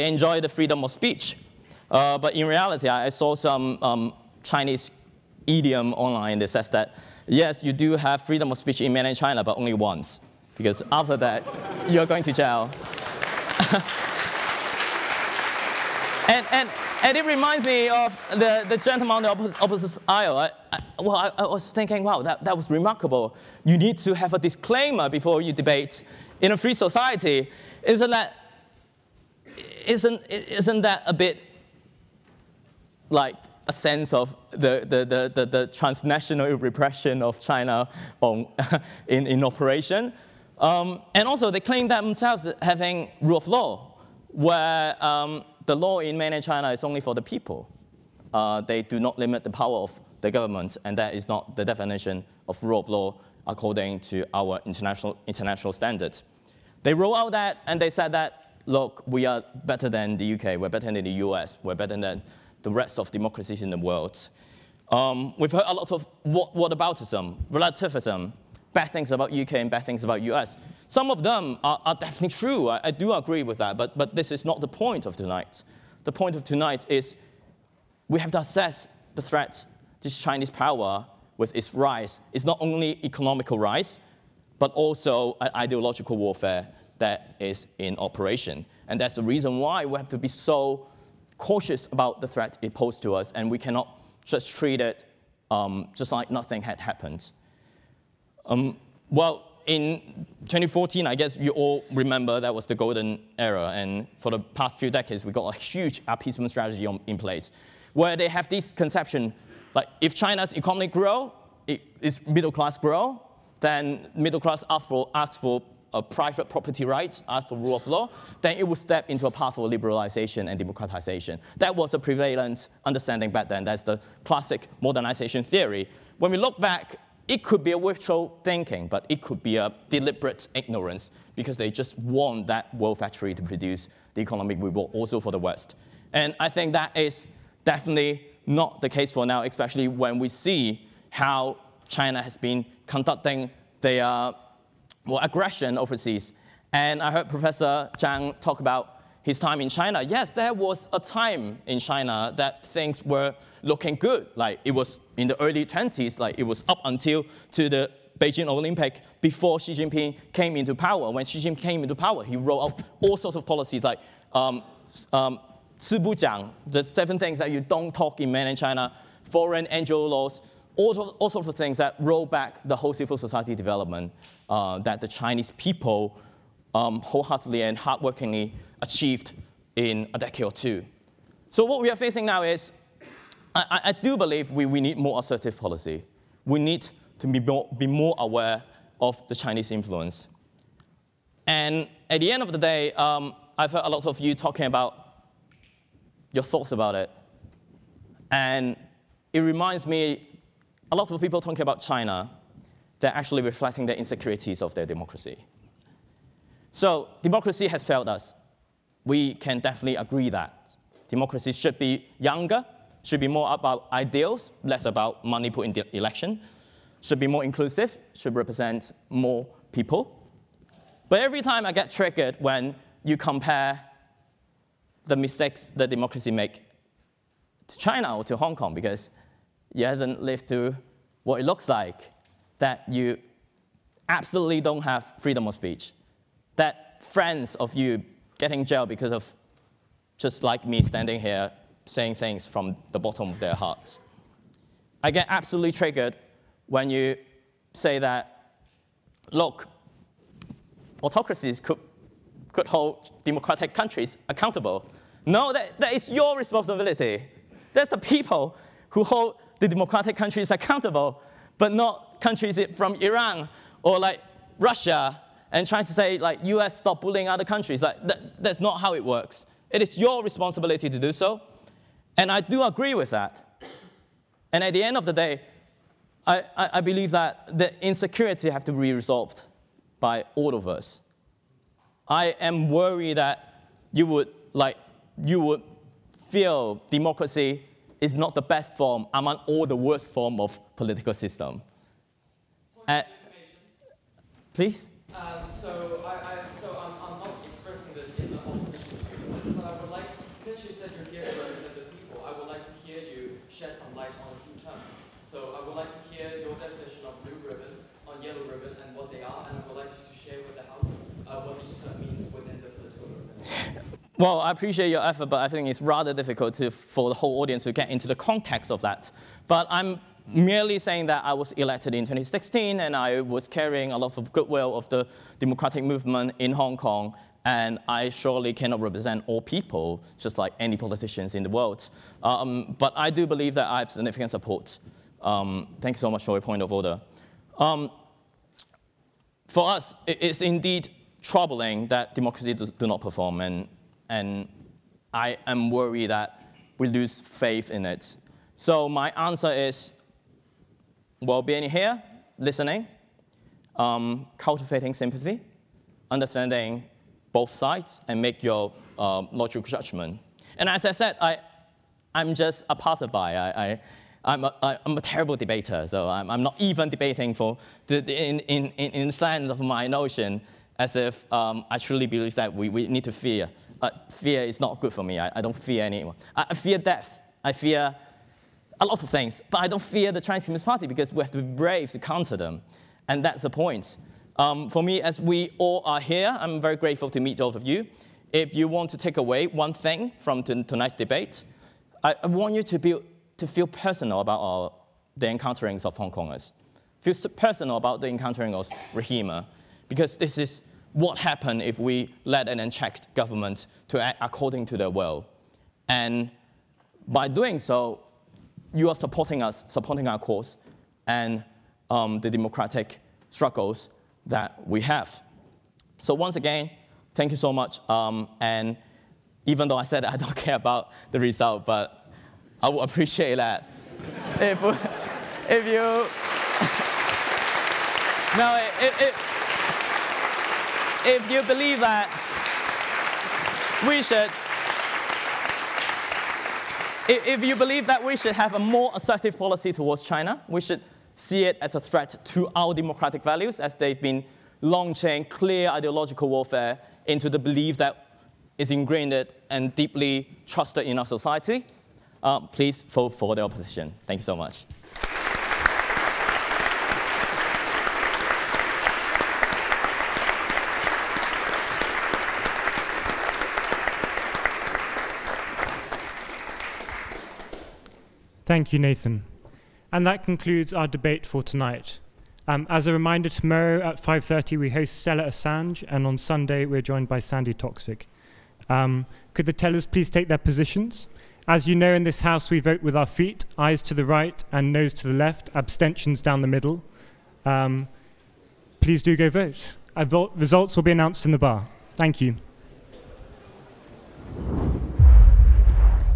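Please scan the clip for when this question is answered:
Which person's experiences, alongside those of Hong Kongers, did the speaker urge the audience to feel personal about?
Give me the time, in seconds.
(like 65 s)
398 s.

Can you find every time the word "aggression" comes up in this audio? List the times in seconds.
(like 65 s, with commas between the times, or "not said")
145 s.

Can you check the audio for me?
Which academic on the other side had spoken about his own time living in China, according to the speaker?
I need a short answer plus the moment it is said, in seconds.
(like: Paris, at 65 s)
Professor Zhang, at 147 s.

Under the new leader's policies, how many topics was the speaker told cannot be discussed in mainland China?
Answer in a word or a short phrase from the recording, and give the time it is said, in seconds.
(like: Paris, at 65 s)
7, at 166 s.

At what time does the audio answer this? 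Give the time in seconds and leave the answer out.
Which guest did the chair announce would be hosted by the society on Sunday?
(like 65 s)
477 s.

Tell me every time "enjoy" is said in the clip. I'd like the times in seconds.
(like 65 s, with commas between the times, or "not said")
0 s.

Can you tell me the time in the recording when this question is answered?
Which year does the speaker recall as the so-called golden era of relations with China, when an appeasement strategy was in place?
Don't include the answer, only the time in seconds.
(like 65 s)
100 s.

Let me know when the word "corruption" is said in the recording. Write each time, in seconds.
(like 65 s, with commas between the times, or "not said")
not said.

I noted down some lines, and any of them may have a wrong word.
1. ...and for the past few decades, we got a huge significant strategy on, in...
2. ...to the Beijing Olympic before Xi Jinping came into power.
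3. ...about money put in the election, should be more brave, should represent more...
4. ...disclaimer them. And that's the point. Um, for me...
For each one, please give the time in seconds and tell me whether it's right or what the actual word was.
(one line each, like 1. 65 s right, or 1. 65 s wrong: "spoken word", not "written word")
1. 103 s wrong: "appeasement", not "significant"
2. 157 s right
3. 214 s wrong: "inclusive", not "brave"
4. 381 s wrong: "counter", not "disclaimer".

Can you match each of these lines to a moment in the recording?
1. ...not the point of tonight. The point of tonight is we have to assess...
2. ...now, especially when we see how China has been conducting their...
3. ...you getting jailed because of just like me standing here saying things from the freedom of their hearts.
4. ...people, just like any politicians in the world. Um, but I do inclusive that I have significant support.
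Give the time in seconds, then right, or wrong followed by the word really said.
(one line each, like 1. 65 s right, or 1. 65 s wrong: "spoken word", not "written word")
1. 74 s right
2. 139 s right
3. 237 s wrong: "bottom", not "freedom"
4. 329 s wrong: "believe", not "inclusive".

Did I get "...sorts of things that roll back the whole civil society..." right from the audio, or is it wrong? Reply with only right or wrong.
right.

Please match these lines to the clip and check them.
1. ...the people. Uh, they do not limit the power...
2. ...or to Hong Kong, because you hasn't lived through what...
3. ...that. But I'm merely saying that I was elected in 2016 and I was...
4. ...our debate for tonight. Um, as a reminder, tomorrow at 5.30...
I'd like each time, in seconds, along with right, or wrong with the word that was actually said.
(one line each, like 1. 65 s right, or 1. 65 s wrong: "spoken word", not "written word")
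1. 47 s right
2. 228 s right
3. 318 s right
4. 470 s right.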